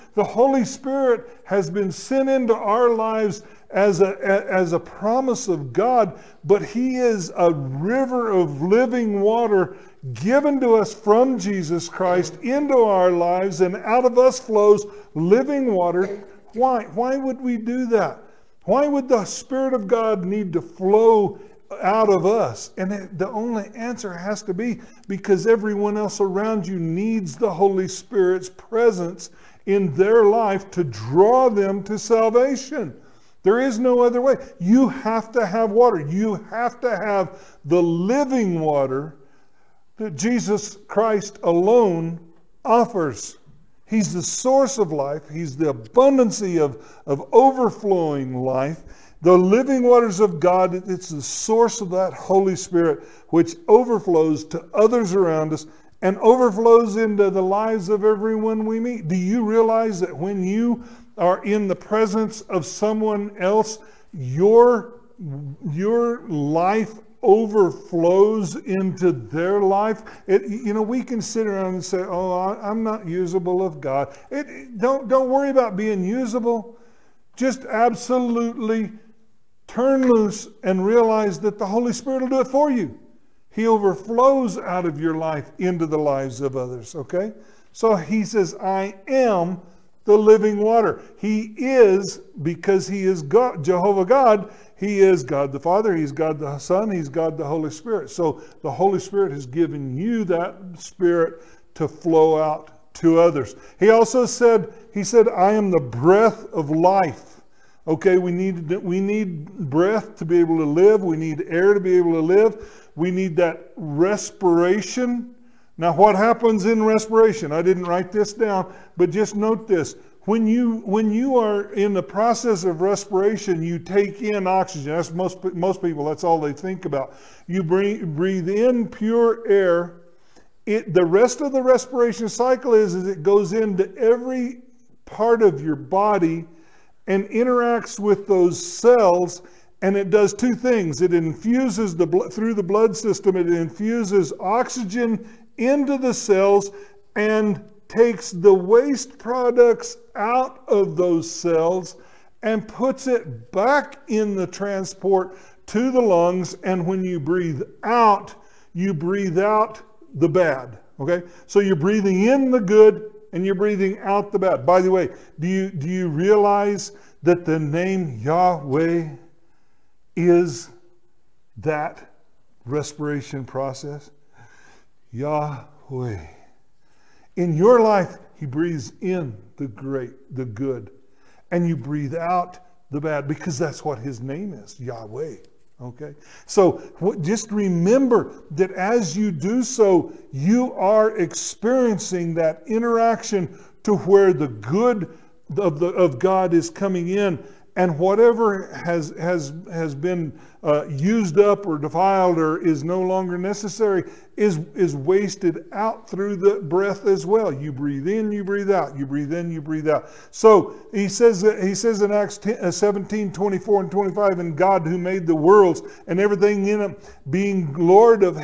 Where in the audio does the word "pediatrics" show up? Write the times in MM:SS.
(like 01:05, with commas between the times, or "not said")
not said.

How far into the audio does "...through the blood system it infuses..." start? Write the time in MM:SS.
02:22.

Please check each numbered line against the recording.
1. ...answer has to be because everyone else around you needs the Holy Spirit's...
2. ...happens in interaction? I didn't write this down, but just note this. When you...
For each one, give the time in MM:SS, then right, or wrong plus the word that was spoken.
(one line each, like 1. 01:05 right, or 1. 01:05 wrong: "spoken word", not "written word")
1. 00:23 right
2. 01:56 wrong: "respiration", not "interaction".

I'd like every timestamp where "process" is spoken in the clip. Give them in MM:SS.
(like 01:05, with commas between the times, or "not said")
02:02, 02:53.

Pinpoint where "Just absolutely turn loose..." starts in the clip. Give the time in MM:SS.
01:17.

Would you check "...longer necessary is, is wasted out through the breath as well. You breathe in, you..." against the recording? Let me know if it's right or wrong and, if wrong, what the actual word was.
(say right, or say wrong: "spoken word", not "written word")
right.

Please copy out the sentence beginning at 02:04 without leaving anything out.
That's most, most people, that's all they think about.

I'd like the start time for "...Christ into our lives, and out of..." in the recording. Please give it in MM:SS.
00:11.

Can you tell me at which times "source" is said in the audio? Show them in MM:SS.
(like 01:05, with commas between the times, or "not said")
00:44, 00:51.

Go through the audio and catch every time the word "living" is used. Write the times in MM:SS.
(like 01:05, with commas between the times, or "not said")
00:08, 00:15, 00:37, 00:49, 01:30.